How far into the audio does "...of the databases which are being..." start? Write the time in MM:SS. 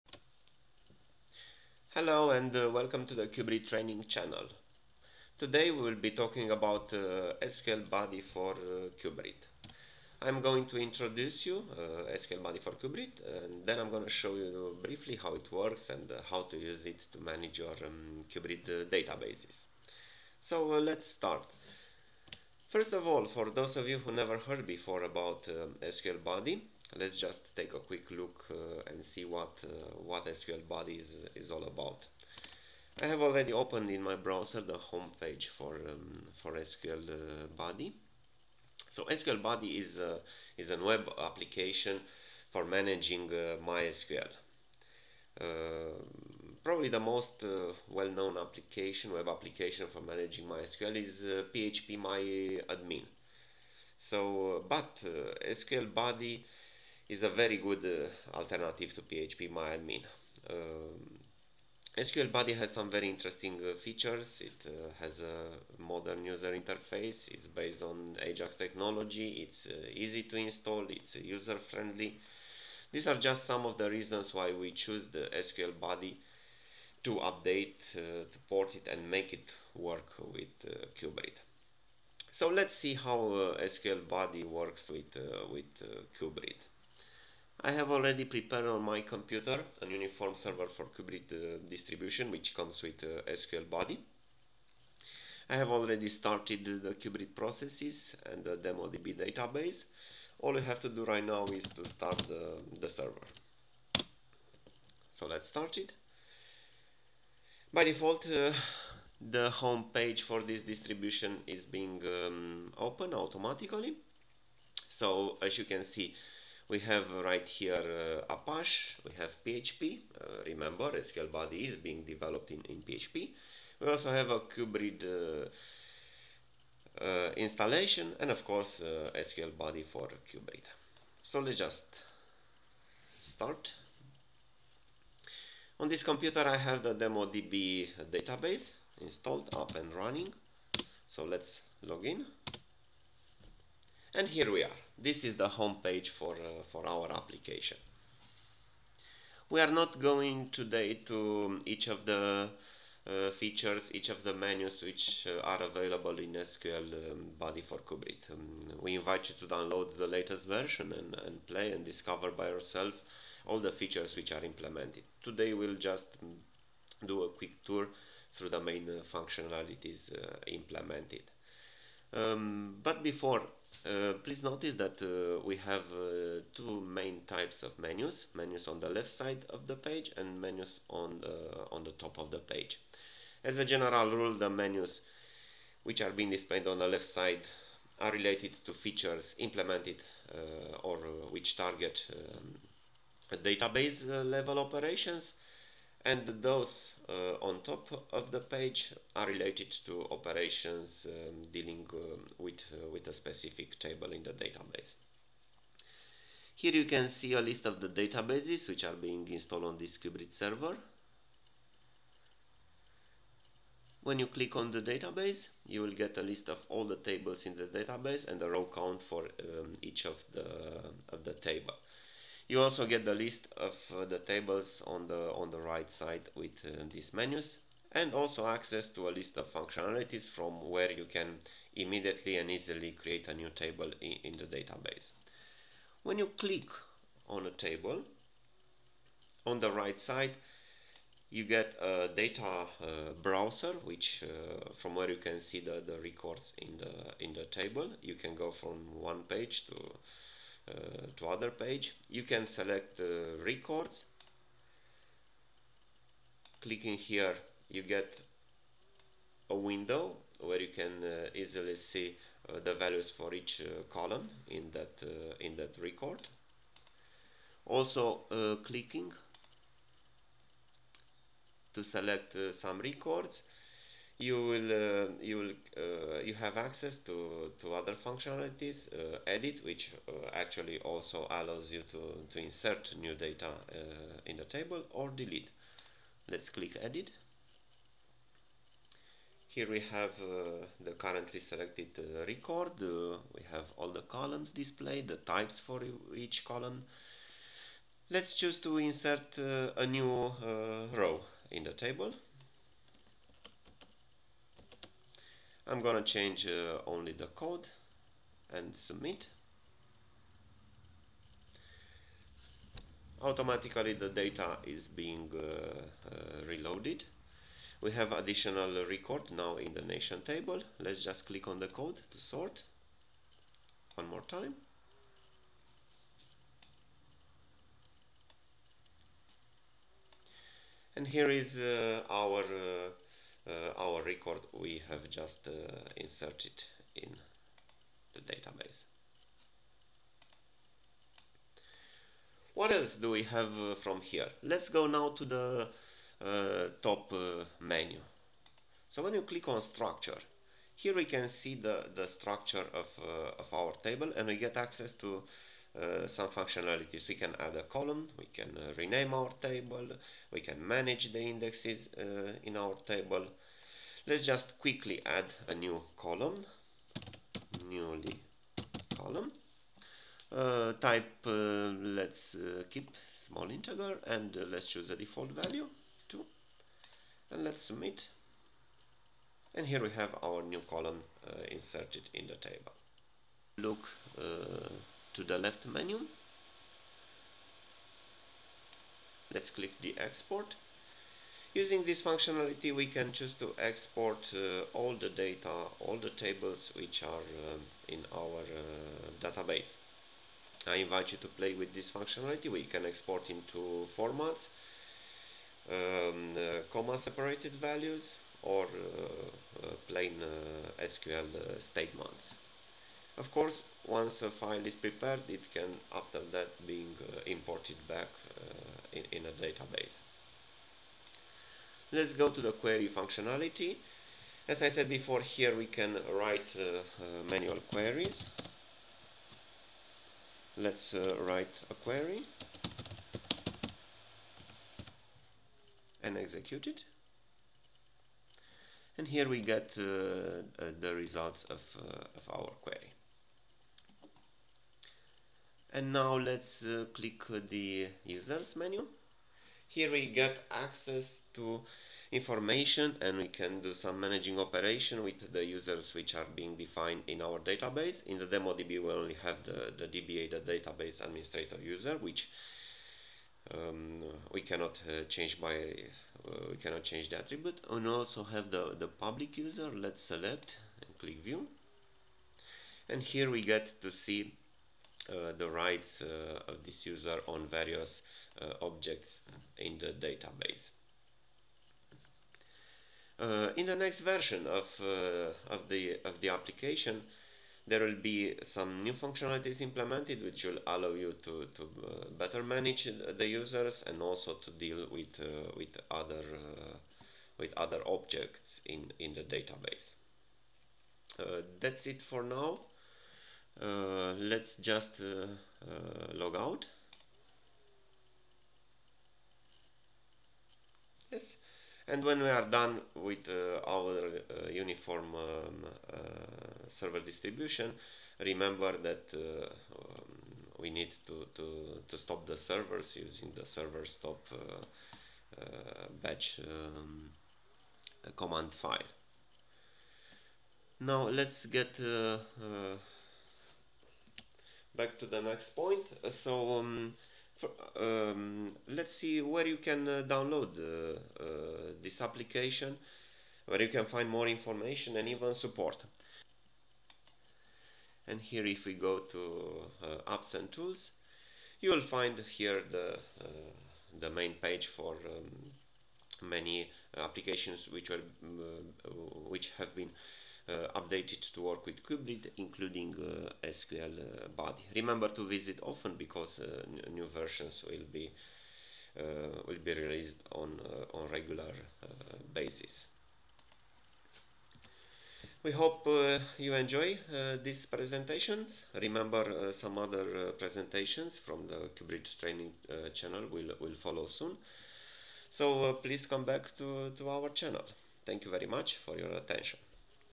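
03:27.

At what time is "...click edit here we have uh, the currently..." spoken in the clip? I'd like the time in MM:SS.
04:46.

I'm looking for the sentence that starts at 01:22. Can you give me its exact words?
So let's see how SQL Buddy works with, with CUBRID.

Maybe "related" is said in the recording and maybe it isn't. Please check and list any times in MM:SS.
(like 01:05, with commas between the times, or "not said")
03:08, 03:19.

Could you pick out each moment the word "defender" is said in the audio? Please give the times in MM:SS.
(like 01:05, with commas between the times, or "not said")
not said.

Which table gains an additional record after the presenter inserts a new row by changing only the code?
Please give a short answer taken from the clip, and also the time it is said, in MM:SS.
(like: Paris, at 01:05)
nation, at 05:19.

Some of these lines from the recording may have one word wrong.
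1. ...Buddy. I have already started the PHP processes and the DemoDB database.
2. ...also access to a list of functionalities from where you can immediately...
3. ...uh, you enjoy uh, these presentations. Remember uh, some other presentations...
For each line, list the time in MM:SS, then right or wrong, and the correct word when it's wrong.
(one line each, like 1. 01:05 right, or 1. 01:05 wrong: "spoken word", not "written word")
1. 01:33 wrong: "CUBRID", not "PHP"
2. 03:48 right
3. 09:35 right.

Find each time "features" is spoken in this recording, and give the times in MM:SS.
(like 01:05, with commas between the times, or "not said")
01:03, 02:33, 02:43, 03:08.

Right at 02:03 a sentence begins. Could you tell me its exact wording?
We also have a CUBRID uh, uh, installation and of course uh, SQL Buddy for CUBRID.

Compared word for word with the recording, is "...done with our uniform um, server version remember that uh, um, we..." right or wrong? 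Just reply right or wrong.
wrong.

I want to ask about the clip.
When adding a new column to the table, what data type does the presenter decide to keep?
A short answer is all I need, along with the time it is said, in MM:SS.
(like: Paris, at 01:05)
small integer, at 06:13.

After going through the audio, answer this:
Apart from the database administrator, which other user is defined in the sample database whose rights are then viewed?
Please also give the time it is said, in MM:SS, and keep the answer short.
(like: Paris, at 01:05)
public, at 07:49.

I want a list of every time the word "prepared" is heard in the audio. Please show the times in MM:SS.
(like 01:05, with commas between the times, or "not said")
01:28, 06:54.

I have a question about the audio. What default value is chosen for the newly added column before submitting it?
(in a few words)
2.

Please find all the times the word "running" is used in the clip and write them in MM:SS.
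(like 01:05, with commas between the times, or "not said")
02:19.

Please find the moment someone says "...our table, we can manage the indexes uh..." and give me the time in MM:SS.
05:59.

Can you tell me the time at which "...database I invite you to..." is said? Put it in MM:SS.
06:39.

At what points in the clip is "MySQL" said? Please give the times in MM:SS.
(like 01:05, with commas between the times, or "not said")
00:43, 00:50.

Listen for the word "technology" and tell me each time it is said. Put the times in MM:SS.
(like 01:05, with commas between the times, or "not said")
01:08.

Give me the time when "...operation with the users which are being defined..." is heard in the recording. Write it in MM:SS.
07:34.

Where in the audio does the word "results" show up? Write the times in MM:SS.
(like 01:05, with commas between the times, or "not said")
07:20.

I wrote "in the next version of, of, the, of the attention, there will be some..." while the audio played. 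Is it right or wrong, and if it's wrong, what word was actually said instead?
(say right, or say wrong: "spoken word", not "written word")
wrong: "application", not "attention".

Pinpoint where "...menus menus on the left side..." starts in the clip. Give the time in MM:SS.
02:57.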